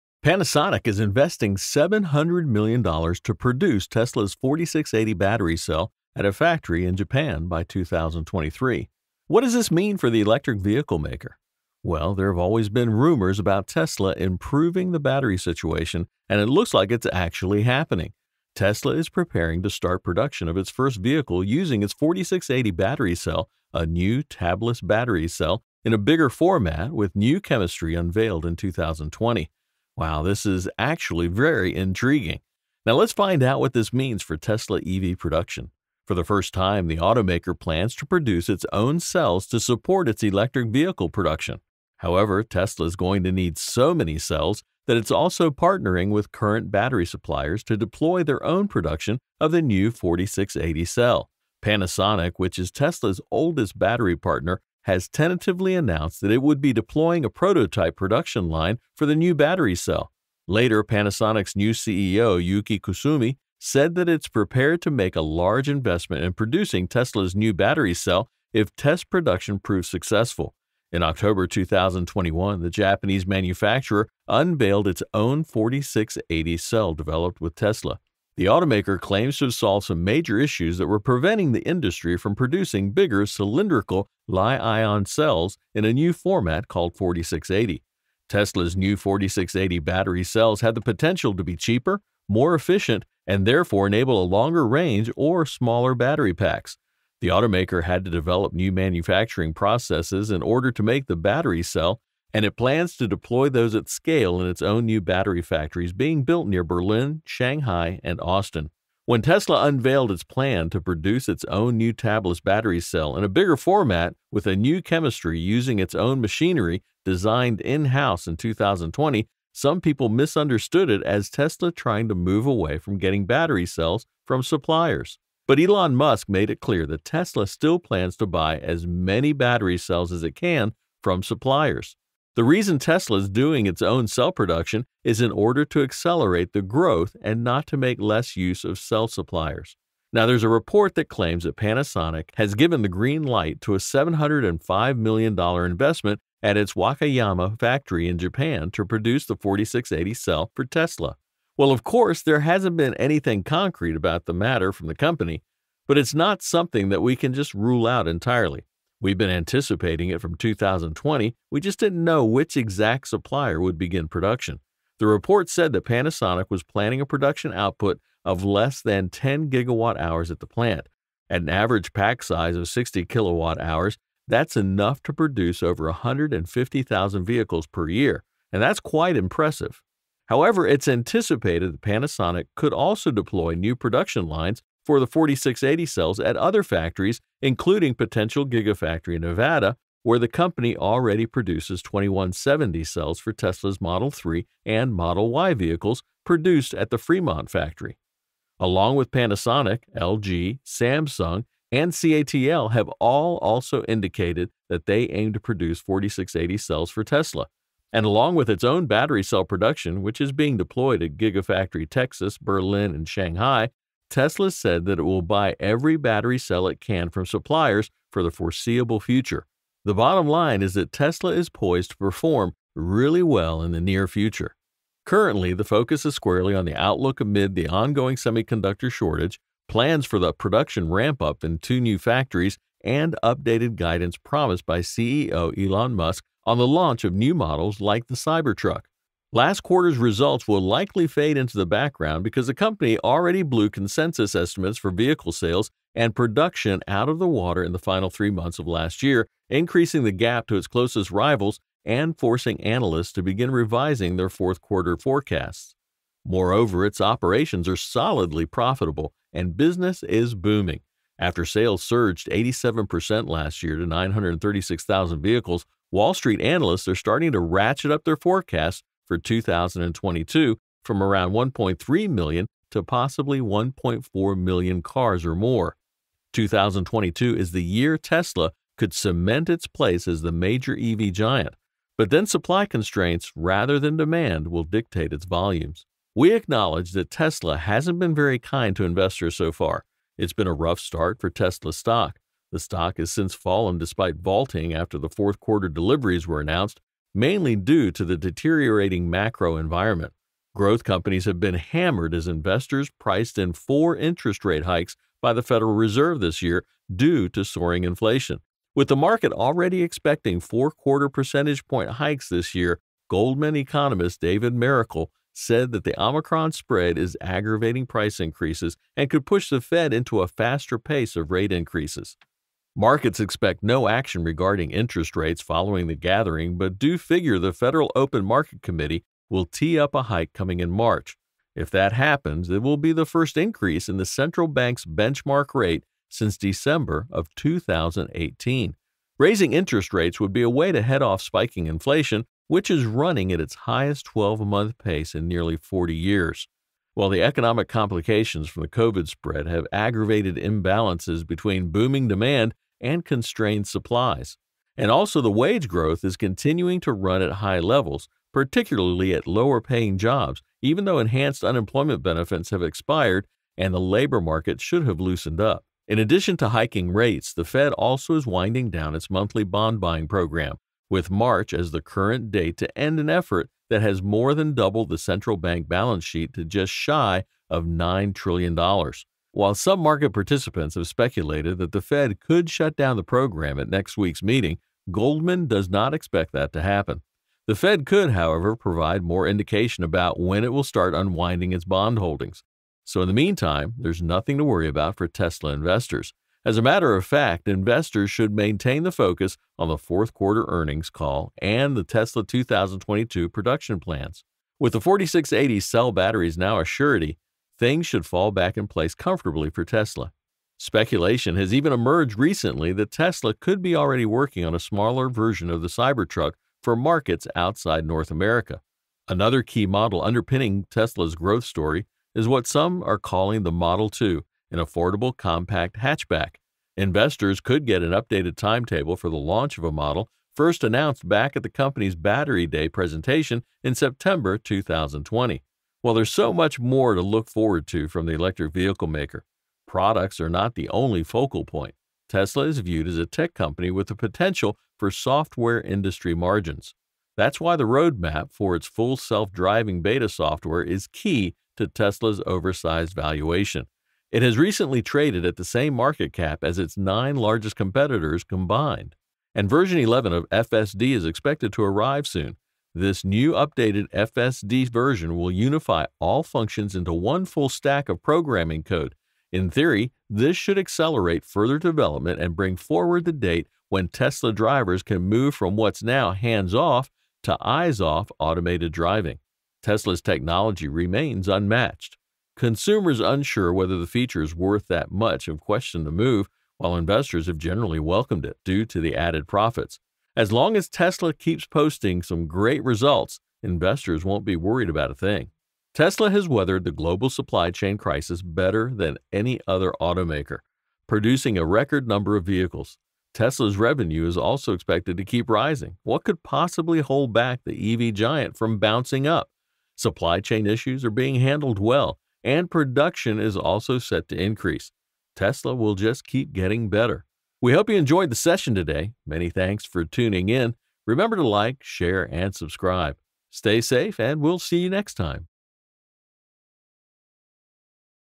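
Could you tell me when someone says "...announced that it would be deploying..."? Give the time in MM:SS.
00:55.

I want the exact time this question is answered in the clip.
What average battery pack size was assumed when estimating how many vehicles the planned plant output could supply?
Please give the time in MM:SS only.
02:52.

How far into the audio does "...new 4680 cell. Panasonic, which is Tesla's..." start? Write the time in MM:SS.
00:49.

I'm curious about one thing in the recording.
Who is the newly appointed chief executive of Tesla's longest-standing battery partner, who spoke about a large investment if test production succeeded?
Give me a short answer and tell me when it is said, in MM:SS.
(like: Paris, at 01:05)
Yuki Kusumi, at 01:02.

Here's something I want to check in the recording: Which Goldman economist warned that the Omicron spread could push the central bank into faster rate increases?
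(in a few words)
David Mericle.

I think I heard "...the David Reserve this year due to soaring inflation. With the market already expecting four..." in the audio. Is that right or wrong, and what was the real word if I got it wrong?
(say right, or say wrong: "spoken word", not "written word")
wrong: "Federal", not "David".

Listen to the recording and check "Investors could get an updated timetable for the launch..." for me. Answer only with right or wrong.
right.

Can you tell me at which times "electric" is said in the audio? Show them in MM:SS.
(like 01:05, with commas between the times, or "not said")
00:10, 00:40, 07:18.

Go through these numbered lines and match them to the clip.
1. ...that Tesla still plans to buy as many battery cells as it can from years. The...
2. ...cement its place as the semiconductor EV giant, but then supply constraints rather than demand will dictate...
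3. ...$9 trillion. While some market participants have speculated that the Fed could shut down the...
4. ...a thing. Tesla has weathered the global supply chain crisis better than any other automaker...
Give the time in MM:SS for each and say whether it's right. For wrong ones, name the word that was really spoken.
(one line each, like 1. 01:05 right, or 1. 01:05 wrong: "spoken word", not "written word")
1. 02:06 wrong: "suppliers", not "years"
2. 04:38 wrong: "major", not "semiconductor"
3. 06:17 right
4. 08:14 right.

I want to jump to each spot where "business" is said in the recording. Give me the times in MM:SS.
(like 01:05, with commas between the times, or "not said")
04:19.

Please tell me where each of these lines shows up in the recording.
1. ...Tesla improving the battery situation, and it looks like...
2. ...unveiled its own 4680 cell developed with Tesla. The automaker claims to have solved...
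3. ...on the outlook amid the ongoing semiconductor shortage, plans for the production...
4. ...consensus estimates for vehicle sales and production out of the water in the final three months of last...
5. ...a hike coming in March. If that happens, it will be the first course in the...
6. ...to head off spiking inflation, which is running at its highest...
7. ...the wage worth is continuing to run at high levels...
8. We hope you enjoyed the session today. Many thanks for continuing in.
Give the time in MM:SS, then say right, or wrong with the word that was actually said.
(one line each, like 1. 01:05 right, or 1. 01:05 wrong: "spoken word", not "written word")
1. 00:13 right
2. 01:14 right
3. 03:46 right
4. 04:03 right
5. 05:29 wrong: "increase", not "course"
6. 05:40 right
7. 05:55 wrong: "growth", not "worth"
8. 08:37 wrong: "tuning", not "continuing".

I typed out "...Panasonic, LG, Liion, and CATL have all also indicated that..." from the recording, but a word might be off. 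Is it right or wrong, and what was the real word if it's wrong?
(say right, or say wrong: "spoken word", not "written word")
wrong: "Samsung", not "Liion".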